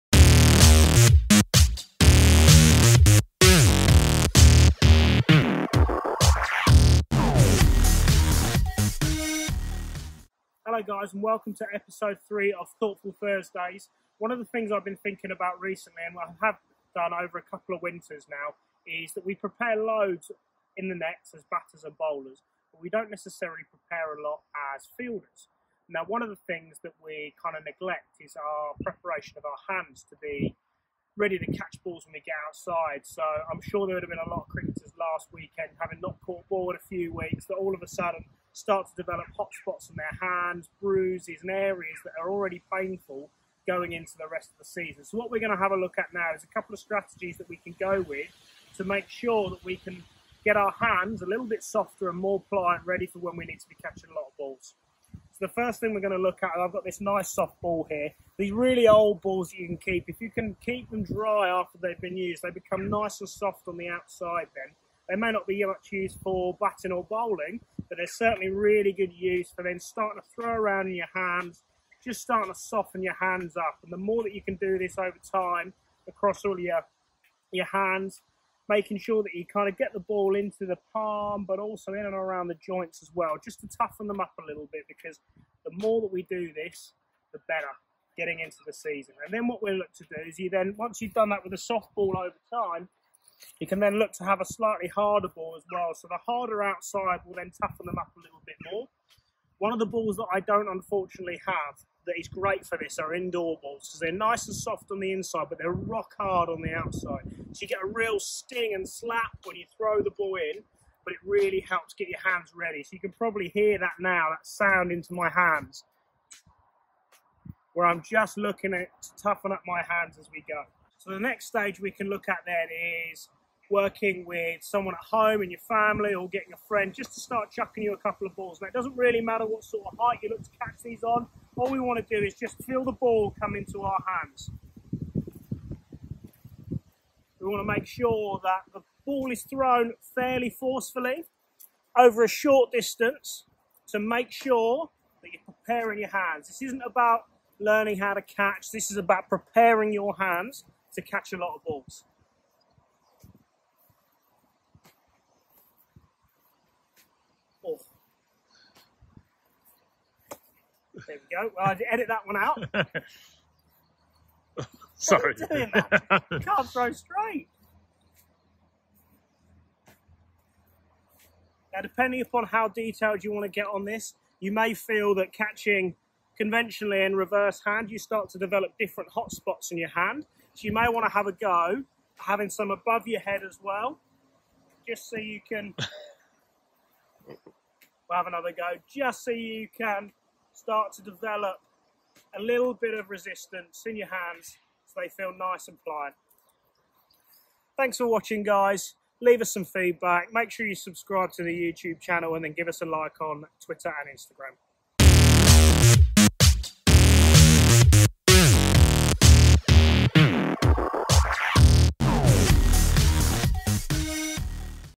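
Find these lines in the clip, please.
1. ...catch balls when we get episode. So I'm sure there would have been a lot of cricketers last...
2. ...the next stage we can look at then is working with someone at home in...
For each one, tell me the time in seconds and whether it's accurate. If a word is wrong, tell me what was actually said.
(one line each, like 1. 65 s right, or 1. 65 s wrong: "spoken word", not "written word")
1. 31 s wrong: "outside", not "episode"
2. 121 s right.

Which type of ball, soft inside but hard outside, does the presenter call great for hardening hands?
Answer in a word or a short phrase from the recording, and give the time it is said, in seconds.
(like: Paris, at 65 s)
Indoor balls, at 103 s.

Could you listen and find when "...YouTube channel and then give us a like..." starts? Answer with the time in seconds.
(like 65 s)
201 s.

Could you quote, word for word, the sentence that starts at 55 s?
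So, the first thing we're going to look at, I've got this nice soft ball here.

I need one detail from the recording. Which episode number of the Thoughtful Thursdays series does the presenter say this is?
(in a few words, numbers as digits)
3.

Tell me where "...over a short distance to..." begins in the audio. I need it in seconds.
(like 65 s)
141 s.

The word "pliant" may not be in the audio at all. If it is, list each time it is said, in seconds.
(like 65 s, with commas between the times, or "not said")
52 s, 195 s.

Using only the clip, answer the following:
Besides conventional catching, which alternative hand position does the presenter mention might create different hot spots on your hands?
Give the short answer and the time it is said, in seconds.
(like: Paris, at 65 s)
Reverse hand, at 177 s.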